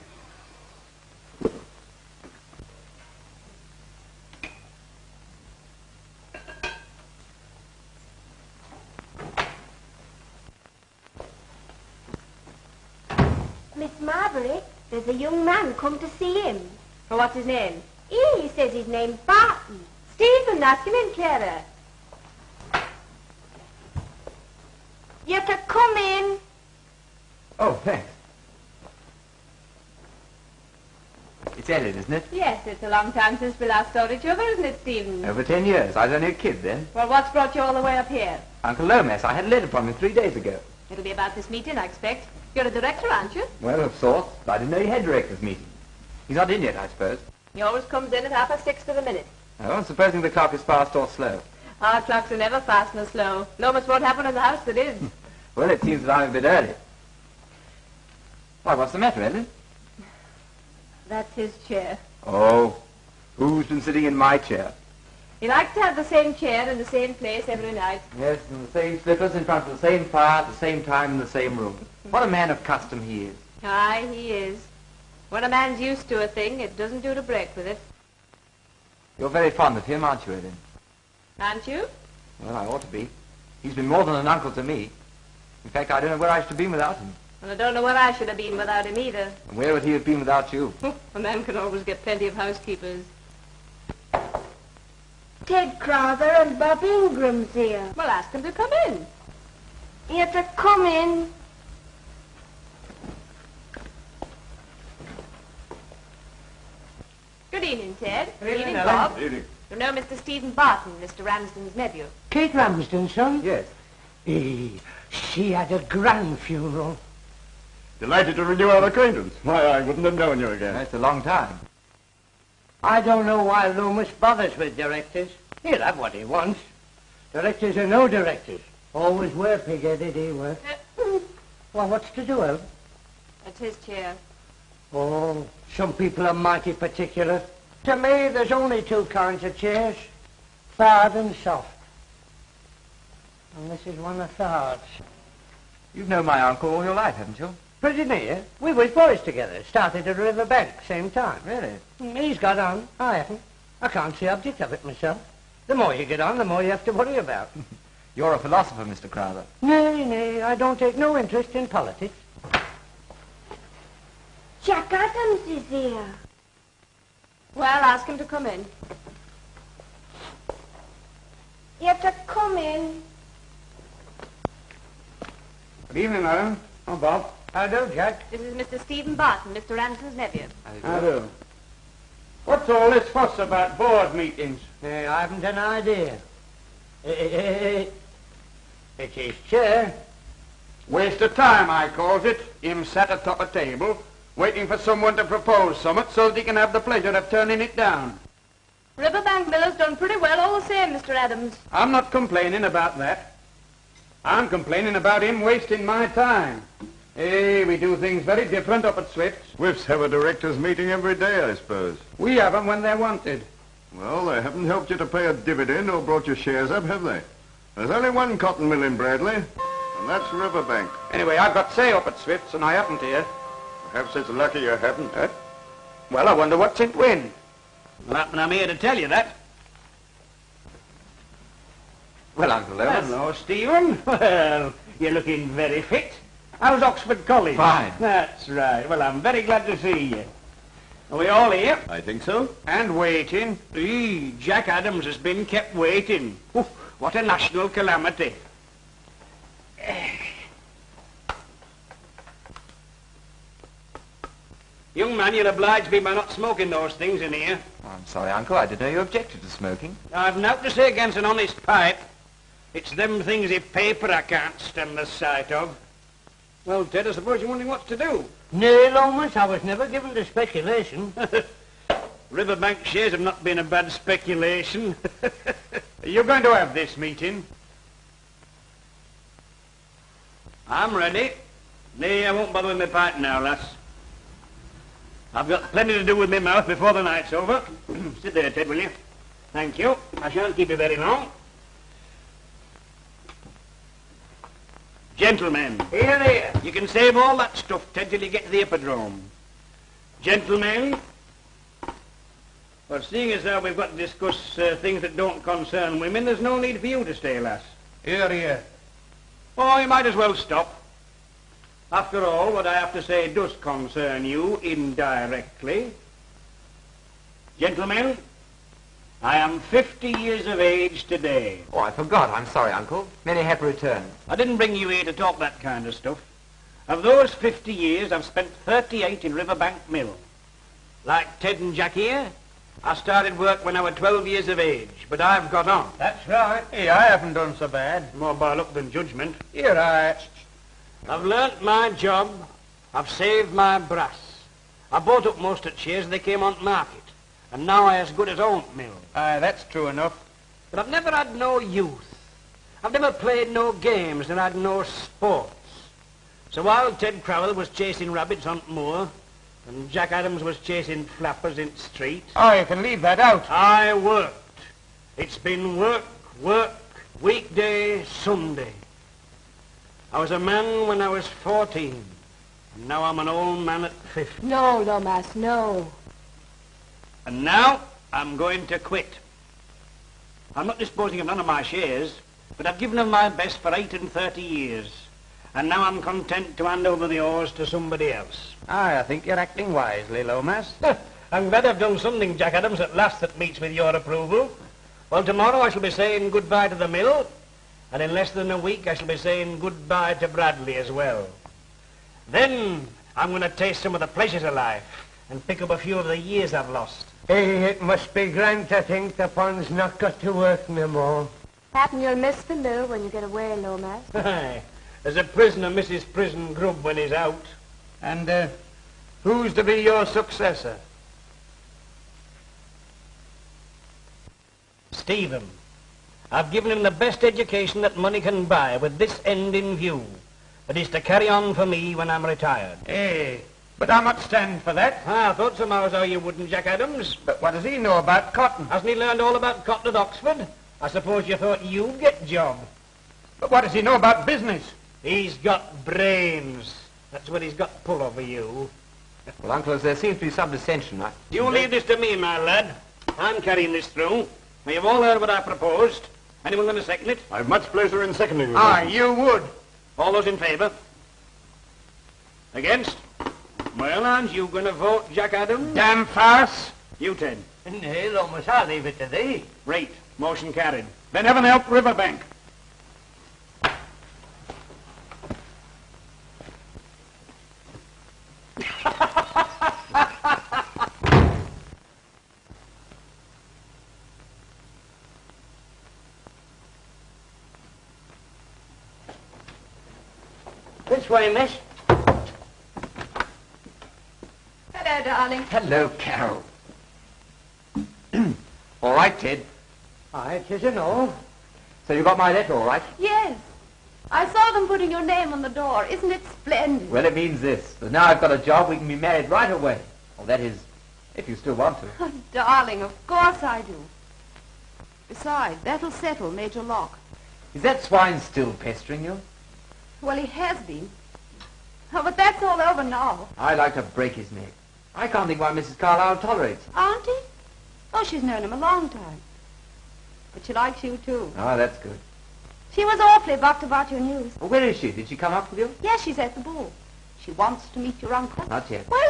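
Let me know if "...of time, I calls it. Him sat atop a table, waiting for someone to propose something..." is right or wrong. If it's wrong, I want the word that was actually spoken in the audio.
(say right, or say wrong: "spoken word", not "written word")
right.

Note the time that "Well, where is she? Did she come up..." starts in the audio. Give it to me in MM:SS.
08:54.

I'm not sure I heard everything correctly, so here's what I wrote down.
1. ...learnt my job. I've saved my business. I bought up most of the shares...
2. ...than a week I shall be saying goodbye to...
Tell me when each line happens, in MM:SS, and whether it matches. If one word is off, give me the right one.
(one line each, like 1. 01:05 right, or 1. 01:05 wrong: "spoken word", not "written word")
1. 05:41 wrong: "brass", not "business"
2. 06:38 right.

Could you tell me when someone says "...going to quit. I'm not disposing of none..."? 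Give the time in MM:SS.
06:18.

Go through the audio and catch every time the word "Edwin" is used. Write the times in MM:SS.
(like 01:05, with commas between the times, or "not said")
01:20.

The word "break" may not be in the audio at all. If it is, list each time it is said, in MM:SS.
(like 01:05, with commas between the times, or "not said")
01:17, 08:43.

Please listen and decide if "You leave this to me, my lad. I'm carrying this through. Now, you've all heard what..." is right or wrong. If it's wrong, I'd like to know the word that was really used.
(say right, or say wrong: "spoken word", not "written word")
right.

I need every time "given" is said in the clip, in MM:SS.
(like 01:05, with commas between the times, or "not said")
04:29, 06:22, 07:06.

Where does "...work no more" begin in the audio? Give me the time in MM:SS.
06:50.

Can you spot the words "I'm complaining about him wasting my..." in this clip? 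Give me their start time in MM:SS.
03:24.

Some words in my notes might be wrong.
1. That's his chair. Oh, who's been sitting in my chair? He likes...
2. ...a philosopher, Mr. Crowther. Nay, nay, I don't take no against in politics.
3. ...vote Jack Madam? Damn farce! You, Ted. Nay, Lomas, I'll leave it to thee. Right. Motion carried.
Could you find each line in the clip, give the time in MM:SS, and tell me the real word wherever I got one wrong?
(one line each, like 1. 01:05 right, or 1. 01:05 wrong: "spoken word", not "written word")
1. 01:01 right
2. 02:38 wrong: "interest", not "against"
3. 07:44 wrong: "Adams", not "Madam".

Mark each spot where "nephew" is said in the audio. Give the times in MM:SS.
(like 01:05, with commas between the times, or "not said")
01:51, 03:00.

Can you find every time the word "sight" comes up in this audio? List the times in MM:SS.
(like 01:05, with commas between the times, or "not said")
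04:25.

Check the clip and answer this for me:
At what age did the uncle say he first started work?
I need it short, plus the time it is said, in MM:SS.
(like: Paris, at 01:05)
12, at 05:33.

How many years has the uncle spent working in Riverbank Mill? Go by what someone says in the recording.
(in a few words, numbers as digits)
38.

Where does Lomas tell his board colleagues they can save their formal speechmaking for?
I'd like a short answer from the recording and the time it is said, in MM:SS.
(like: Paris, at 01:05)
the hippodrome, at 04:58.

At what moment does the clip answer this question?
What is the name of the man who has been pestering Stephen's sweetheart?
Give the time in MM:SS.
08:36.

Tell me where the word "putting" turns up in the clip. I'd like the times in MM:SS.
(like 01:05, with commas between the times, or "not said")
08:24.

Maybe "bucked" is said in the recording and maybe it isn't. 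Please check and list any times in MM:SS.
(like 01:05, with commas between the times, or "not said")
08:53.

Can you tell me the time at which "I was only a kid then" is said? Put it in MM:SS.
00:35.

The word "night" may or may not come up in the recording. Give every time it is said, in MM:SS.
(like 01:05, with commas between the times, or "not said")
01:07, 04:47.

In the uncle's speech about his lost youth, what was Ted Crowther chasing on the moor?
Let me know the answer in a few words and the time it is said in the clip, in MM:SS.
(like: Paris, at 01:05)
rabbits, at 05:58.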